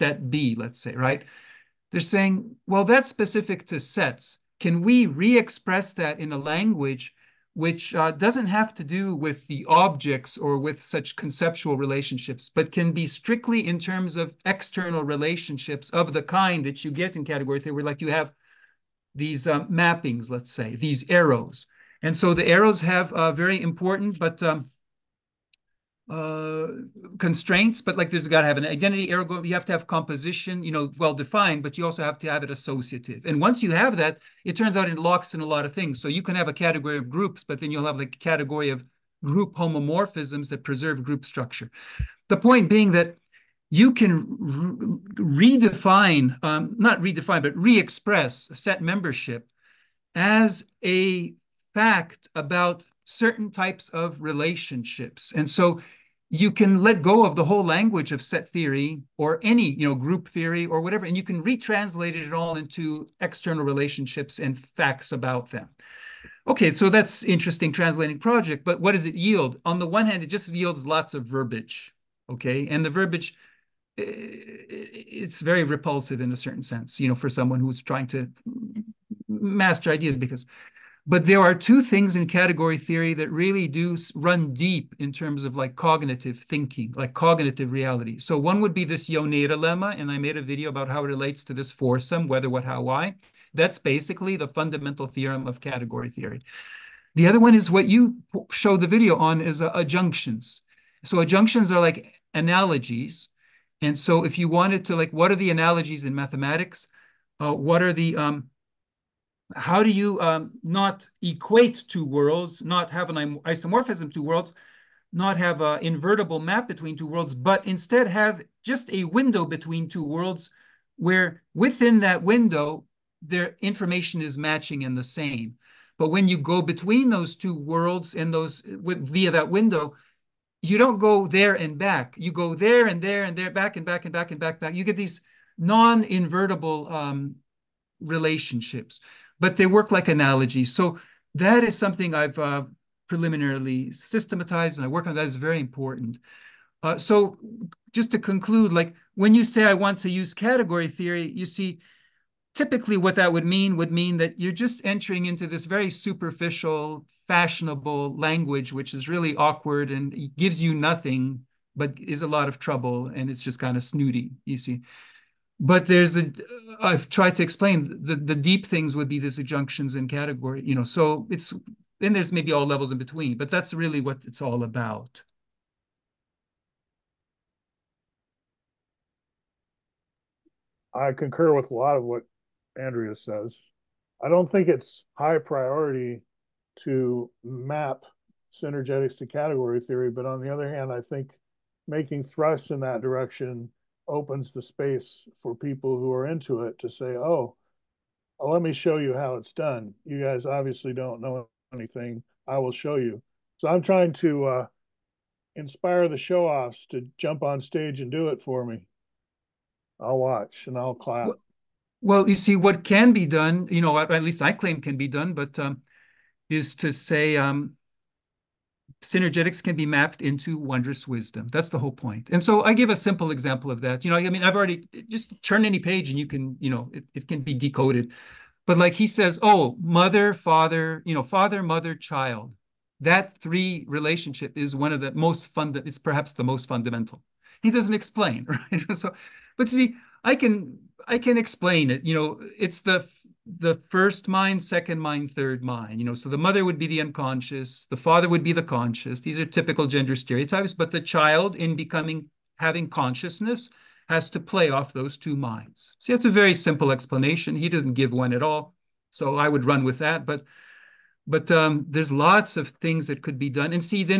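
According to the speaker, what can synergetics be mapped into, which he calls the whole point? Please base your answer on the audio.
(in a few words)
Wondrous wisdom.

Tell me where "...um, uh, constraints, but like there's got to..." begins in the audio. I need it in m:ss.
0:24.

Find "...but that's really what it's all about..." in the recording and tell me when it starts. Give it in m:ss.
2:53.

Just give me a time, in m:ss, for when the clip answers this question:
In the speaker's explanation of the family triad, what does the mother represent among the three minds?
4:06.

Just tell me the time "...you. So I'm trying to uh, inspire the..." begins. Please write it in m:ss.
3:22.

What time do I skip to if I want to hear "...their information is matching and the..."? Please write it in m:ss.
2:03.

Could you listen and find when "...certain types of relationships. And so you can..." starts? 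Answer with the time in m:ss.
0:53.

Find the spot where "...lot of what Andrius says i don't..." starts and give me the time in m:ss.
3:01.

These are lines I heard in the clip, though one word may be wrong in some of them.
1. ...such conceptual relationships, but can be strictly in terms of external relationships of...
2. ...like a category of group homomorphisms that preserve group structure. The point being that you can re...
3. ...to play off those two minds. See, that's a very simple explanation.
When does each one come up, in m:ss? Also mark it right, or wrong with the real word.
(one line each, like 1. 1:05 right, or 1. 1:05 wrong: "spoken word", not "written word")
1. 0:10 right
2. 0:37 right
3. 4:14 right.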